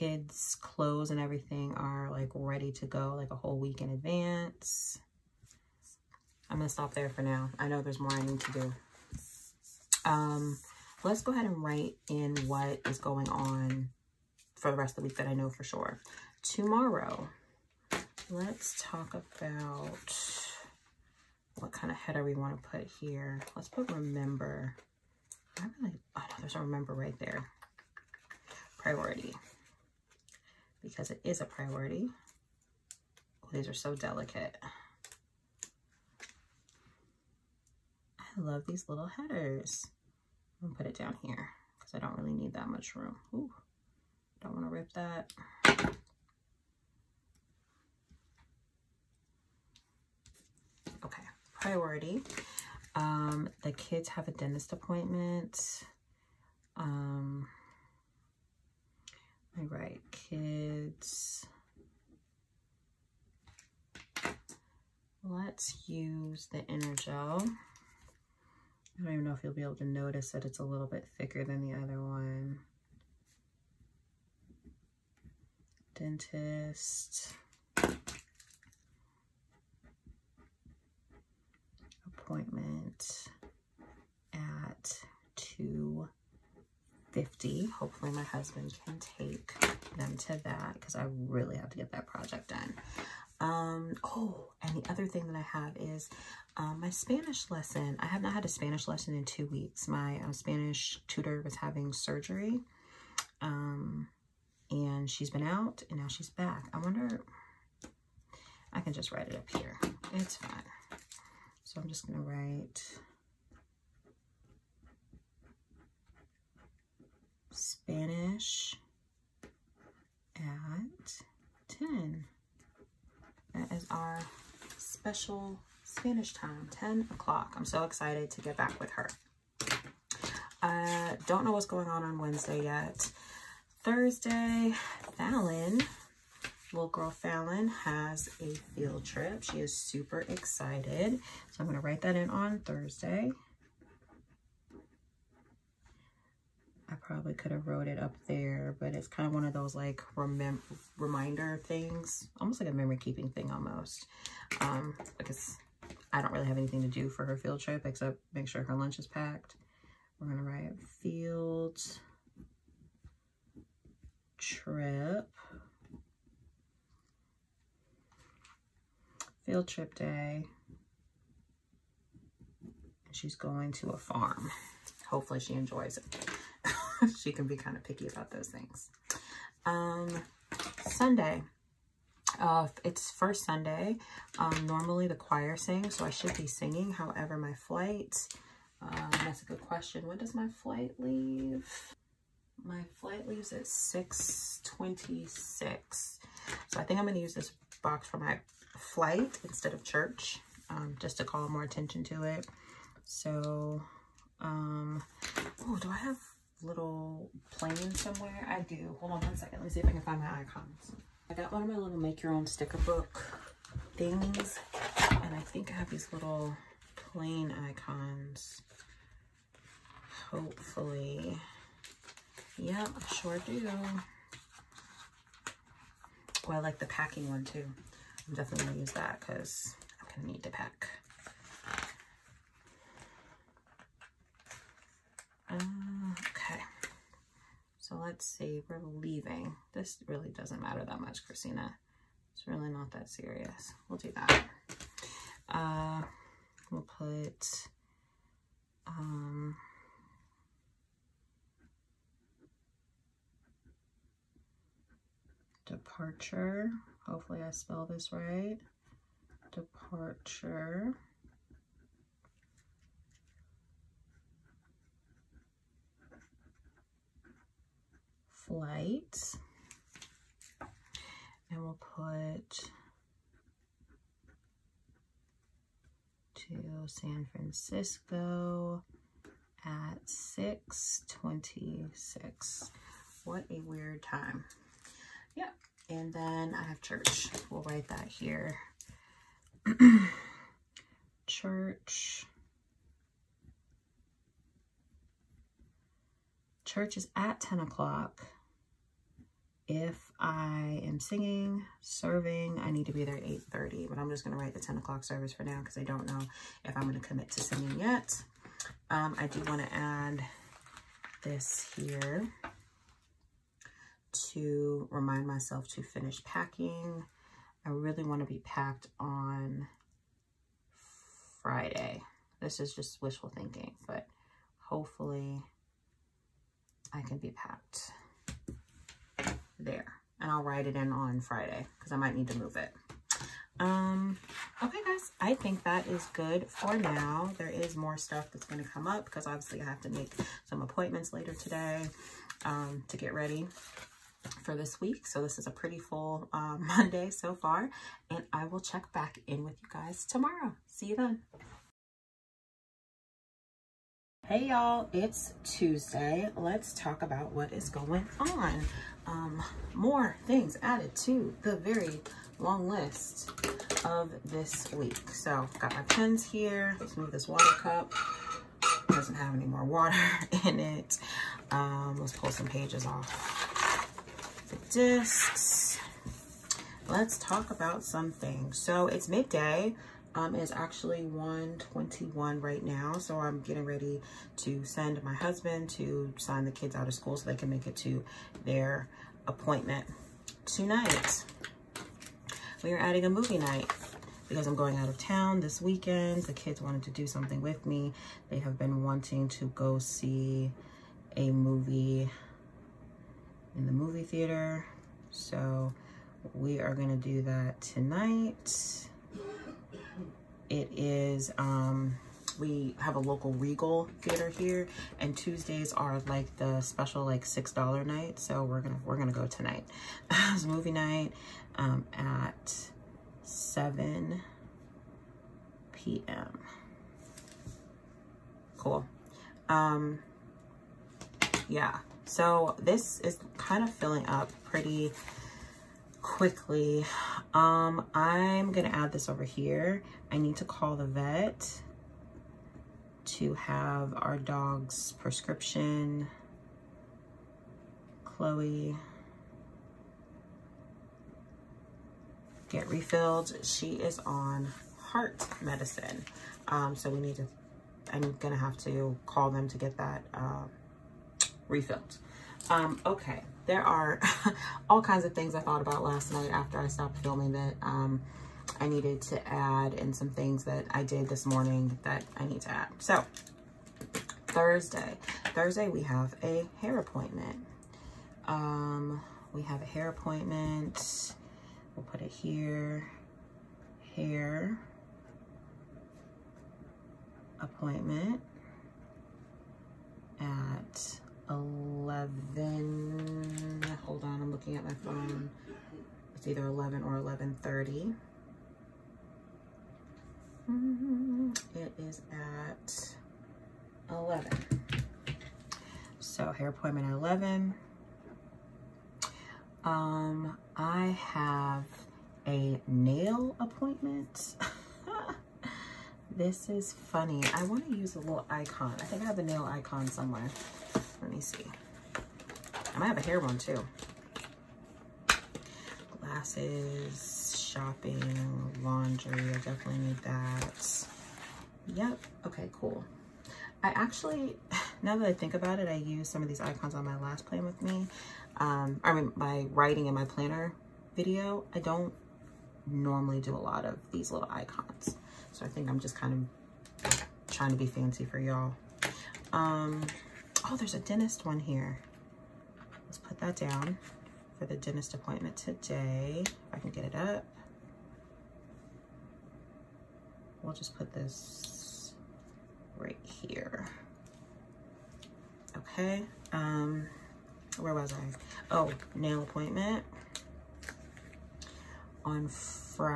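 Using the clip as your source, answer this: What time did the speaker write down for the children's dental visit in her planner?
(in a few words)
2:50.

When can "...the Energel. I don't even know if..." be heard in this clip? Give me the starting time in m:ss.
1:06.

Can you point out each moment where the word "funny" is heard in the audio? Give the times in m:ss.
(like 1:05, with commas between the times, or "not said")
8:36.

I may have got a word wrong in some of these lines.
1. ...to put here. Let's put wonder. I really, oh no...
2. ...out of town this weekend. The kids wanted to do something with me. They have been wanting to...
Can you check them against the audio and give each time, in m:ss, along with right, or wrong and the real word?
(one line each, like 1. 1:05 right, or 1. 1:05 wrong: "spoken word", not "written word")
1. 0:22 wrong: "remember", not "wonder"
2. 6:34 right.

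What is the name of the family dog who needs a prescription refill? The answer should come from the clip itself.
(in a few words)
Chloe.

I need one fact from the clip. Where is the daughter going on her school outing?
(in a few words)
A farm.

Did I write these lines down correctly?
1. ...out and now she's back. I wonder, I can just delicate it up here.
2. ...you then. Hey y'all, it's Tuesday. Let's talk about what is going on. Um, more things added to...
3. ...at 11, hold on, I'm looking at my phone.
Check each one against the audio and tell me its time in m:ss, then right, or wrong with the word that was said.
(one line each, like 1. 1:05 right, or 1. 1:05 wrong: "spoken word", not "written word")
1. 1:45 wrong: "write", not "delicate"
2. 5:50 right
3. 8:10 right.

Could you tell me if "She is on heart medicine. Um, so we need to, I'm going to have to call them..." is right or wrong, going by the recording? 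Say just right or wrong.
right.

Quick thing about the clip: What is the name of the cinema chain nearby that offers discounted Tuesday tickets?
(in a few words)
Regal.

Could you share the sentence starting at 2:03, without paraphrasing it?
That is our special Spanish time, 10 o'clock.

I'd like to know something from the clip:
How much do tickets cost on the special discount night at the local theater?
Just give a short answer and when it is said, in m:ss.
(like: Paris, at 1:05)
$6, at 6:57.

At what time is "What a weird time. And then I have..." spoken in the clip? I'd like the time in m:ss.
4:43.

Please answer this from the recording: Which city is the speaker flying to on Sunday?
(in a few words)
San Francisco.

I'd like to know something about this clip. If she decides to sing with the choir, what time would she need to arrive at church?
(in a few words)
8:30.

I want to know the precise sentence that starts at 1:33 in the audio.
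Um, oh, and the other thing that I have is um, my Spanish lesson.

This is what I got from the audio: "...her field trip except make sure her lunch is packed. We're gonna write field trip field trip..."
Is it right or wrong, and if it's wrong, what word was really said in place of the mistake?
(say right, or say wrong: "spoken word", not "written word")
right.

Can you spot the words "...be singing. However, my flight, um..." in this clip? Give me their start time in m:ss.
3:06.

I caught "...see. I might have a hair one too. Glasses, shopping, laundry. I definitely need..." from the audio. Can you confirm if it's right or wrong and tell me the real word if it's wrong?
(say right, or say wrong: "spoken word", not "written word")
right.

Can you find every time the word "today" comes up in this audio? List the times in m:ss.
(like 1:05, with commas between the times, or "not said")
5:41, 9:15.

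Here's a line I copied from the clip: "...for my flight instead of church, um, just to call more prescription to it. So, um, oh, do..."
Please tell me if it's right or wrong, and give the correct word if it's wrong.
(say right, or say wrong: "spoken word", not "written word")
wrong: "attention", not "prescription".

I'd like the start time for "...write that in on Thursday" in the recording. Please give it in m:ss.
2:21.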